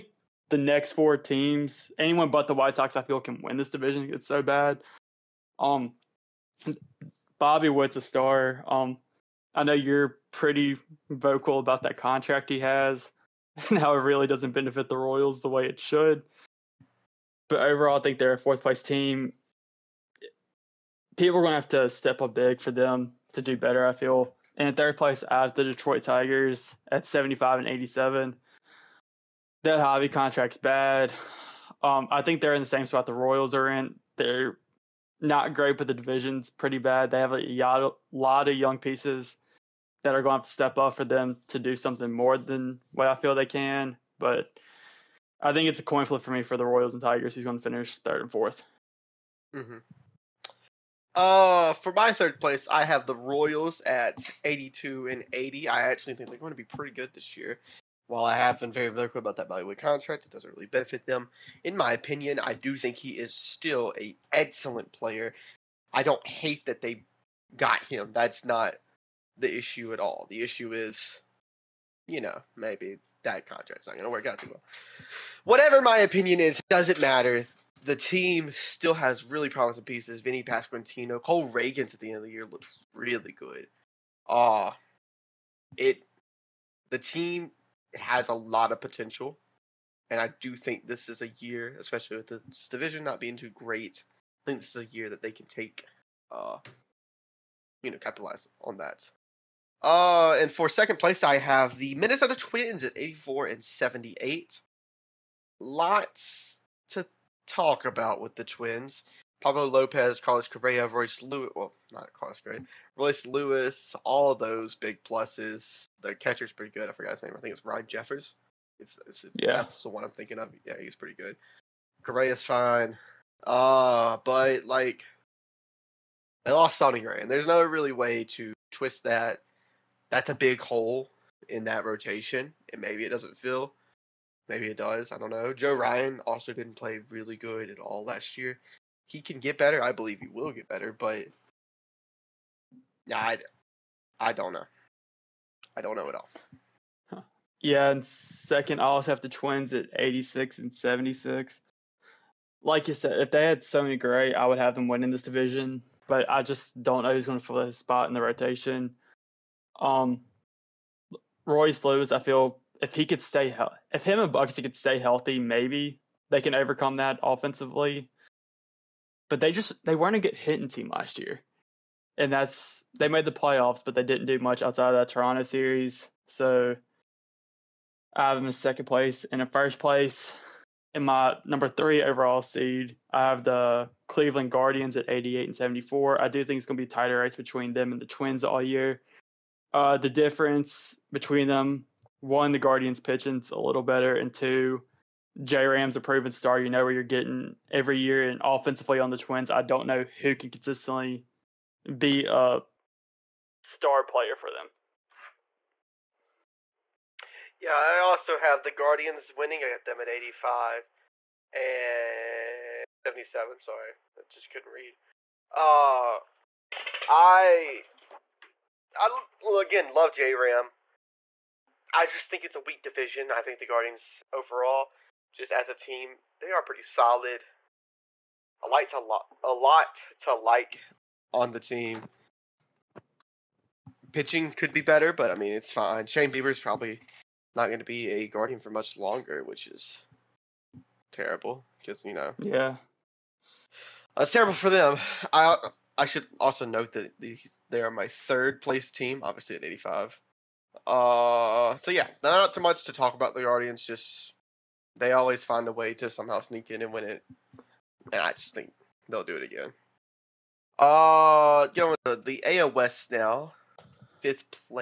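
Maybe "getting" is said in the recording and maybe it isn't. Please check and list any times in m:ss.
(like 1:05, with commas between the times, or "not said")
3:17.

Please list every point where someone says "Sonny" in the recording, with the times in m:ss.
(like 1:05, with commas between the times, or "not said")
2:06, 2:33.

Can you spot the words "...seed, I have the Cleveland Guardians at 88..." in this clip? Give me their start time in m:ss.
3:02.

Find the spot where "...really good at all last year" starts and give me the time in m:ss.
2:17.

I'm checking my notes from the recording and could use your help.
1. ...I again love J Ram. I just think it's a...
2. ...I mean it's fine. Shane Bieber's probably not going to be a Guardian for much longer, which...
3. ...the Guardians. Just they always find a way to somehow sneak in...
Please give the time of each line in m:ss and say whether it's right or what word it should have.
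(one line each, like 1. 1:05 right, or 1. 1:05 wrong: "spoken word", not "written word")
1. 3:38 right
2. 3:55 right
3. 4:13 right.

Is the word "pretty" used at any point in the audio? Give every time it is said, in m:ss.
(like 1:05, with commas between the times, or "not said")
0:10, 0:36, 0:56, 1:56, 2:00, 3:46.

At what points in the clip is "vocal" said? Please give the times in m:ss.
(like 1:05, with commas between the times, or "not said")
0:11, 0:58.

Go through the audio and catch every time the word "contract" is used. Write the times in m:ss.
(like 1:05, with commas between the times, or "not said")
0:11, 0:30, 0:59, 1:13.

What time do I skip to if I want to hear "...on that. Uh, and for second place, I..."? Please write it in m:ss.
1:38.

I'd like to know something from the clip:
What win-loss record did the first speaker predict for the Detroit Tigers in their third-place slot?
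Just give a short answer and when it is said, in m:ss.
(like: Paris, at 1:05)
75 and 87, at 0:27.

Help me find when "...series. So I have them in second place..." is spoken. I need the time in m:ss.
2:55.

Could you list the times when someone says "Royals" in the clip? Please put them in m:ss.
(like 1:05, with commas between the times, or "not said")
0:14, 0:33, 0:46, 0:53.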